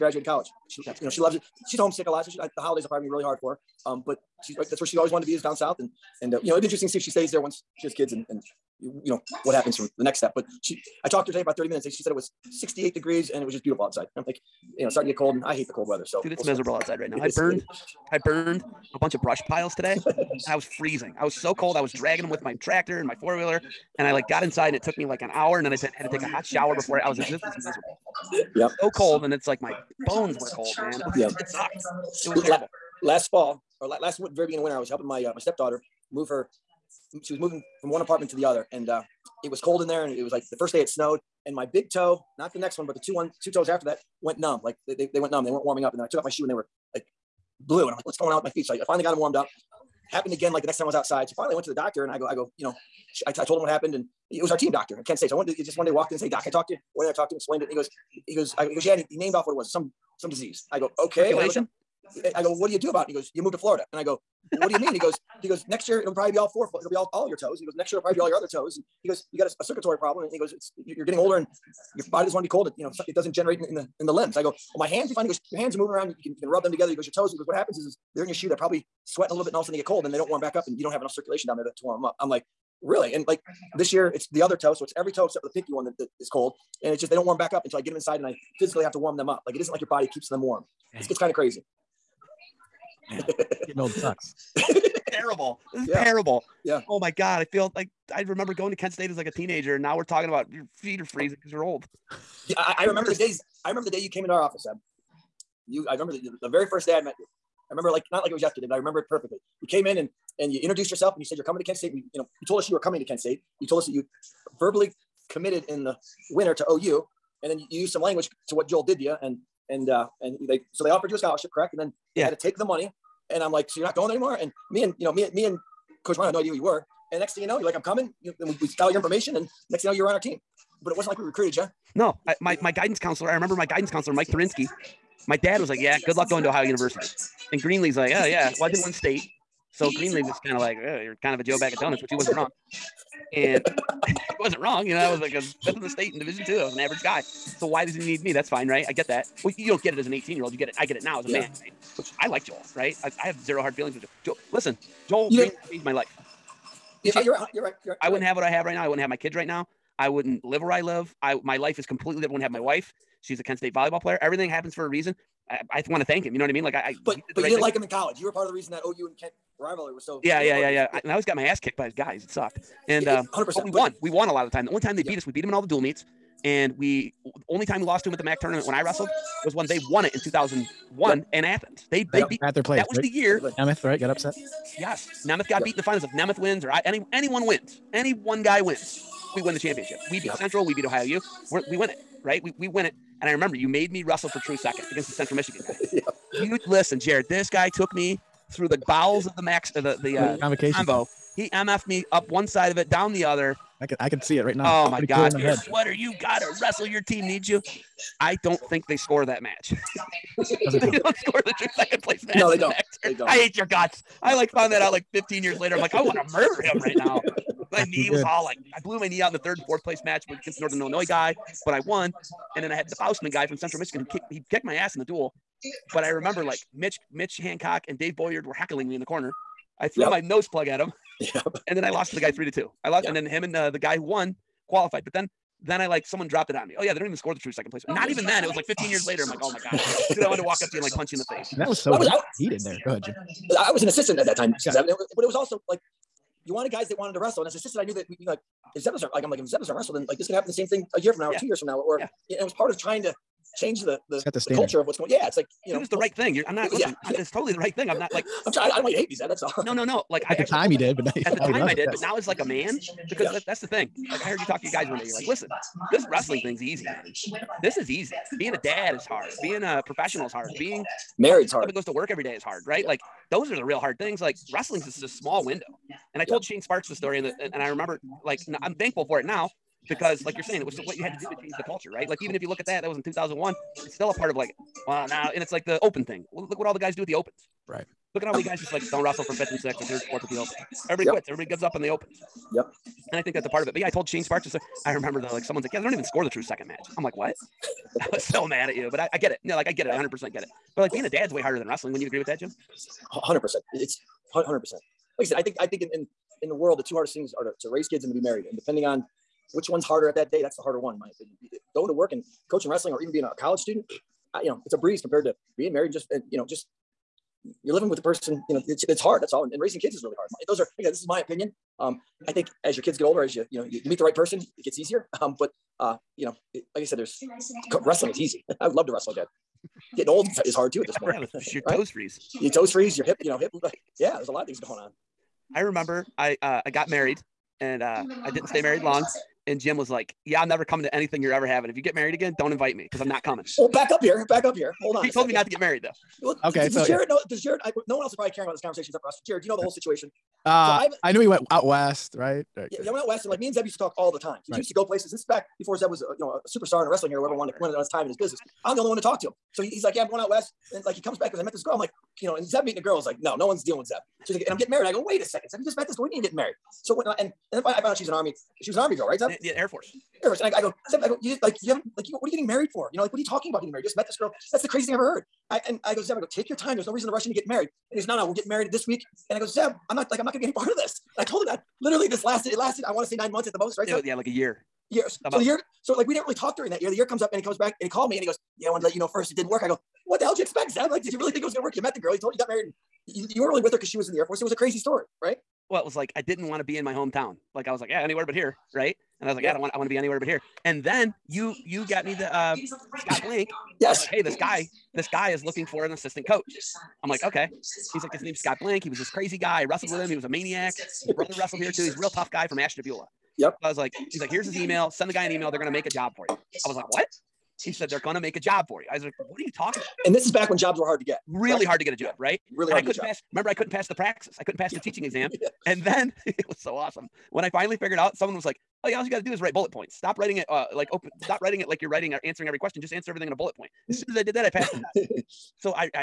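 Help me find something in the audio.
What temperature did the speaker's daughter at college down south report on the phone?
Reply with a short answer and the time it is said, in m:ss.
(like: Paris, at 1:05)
68 degrees, at 0:12.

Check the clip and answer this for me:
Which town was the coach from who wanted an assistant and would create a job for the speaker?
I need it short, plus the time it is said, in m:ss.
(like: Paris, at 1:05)
Ashtabula, at 6:52.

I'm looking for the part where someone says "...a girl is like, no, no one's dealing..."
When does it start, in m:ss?
6:02.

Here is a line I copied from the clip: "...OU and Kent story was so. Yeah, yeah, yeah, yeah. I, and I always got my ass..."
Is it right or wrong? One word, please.
wrong.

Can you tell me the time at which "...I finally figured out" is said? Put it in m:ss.
7:07.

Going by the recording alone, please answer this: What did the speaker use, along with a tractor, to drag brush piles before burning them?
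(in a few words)
four wheeler.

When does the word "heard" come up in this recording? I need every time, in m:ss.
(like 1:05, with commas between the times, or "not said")
4:24, 6:15.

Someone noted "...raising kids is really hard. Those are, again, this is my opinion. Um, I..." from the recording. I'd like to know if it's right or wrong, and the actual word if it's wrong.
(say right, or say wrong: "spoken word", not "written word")
right.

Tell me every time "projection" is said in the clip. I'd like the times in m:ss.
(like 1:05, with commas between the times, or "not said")
not said.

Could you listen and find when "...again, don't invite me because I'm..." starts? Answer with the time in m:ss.
5:42.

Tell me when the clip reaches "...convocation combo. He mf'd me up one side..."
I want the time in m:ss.
3:20.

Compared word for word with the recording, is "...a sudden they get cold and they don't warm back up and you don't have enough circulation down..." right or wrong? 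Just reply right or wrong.
right.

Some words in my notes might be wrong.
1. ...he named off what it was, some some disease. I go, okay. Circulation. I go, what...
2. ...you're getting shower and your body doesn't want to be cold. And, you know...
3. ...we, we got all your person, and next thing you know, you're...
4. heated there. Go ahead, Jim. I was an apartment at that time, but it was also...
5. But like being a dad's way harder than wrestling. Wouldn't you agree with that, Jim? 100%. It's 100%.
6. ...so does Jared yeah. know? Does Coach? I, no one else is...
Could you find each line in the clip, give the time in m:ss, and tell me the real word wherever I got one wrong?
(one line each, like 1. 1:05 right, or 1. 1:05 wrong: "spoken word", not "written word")
1. 0:59 right
2. 1:10 wrong: "older", not "shower"
3. 2:08 wrong: "information", not "person"
4. 4:02 wrong: "assistant", not "apartment"
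5. 5:00 right
6. 5:46 wrong: "Jared", not "Coach".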